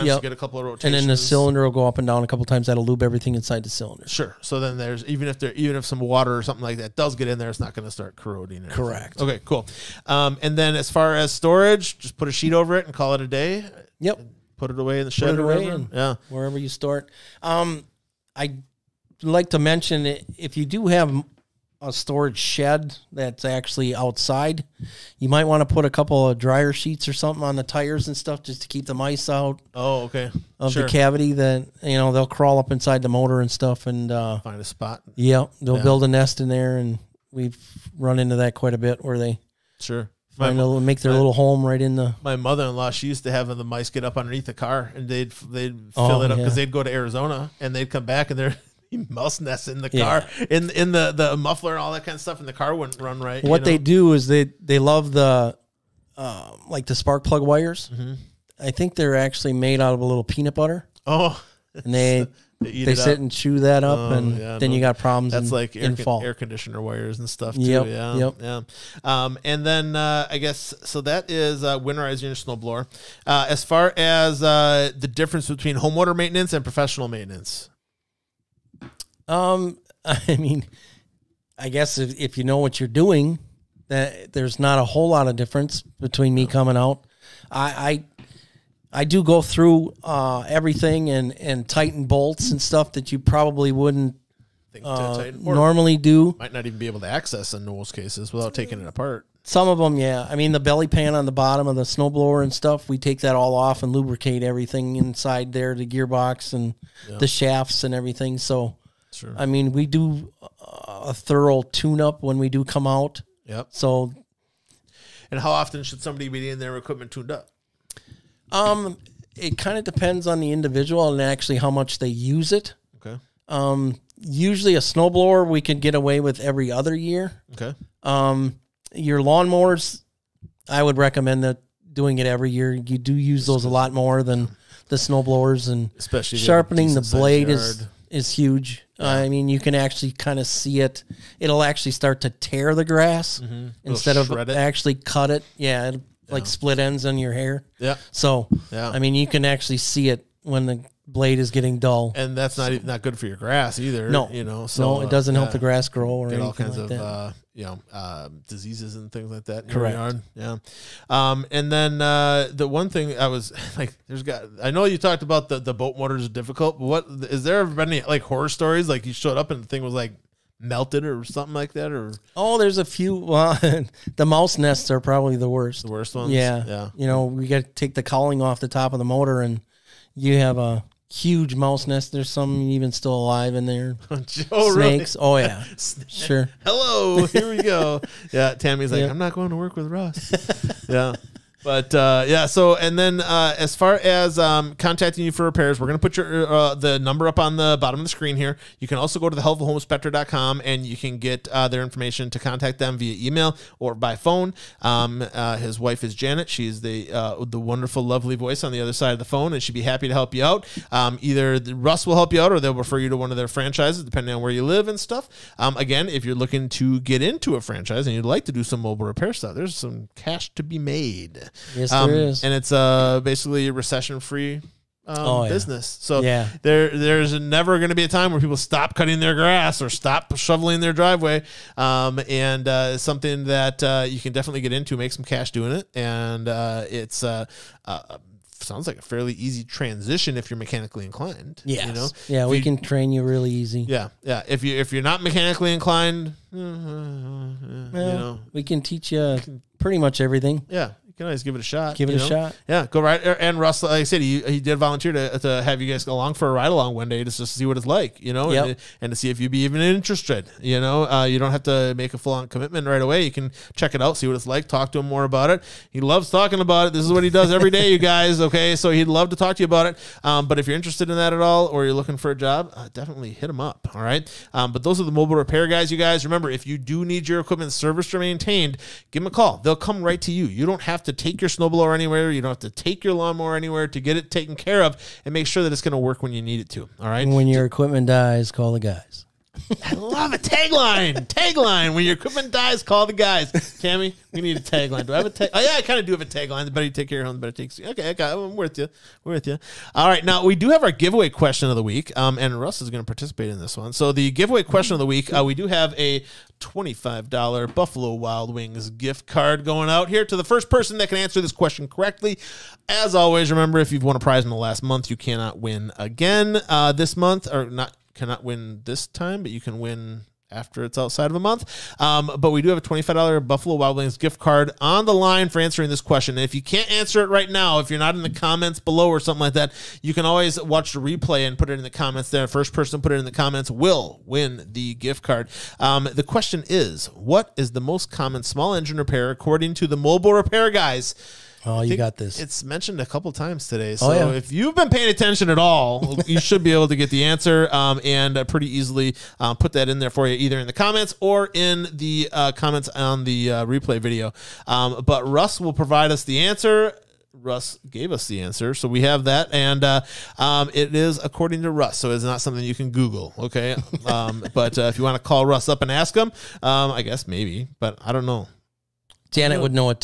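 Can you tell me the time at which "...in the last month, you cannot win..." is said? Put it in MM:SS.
05:14.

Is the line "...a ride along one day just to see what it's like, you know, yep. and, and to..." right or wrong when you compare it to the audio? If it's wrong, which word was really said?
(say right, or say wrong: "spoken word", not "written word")
right.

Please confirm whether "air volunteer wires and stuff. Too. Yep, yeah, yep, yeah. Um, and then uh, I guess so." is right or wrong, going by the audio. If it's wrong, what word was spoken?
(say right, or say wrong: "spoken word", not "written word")
wrong: "conditioner", not "volunteer".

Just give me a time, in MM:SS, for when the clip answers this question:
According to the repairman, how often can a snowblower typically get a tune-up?
02:06.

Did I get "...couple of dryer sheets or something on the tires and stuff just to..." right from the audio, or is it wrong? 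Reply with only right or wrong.
right.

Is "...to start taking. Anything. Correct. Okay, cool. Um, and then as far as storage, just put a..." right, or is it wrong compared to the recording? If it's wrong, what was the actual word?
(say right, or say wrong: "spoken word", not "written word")
wrong: "corroding", not "taking".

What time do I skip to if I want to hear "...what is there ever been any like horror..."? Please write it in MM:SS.
02:46.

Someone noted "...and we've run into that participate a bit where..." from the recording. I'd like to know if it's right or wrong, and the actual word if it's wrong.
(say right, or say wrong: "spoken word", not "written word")
wrong: "quite", not "participate".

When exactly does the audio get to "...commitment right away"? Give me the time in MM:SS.
04:22.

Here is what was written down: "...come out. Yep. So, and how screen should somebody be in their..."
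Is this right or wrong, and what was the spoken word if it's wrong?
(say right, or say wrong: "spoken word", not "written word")
wrong: "often", not "screen".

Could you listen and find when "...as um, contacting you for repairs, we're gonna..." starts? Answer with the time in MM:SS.
03:13.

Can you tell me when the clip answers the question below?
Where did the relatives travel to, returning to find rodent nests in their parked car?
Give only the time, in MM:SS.
00:46.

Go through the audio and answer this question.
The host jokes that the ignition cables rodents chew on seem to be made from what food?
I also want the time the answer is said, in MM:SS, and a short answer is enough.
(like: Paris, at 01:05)
peanut butter, at 01:00.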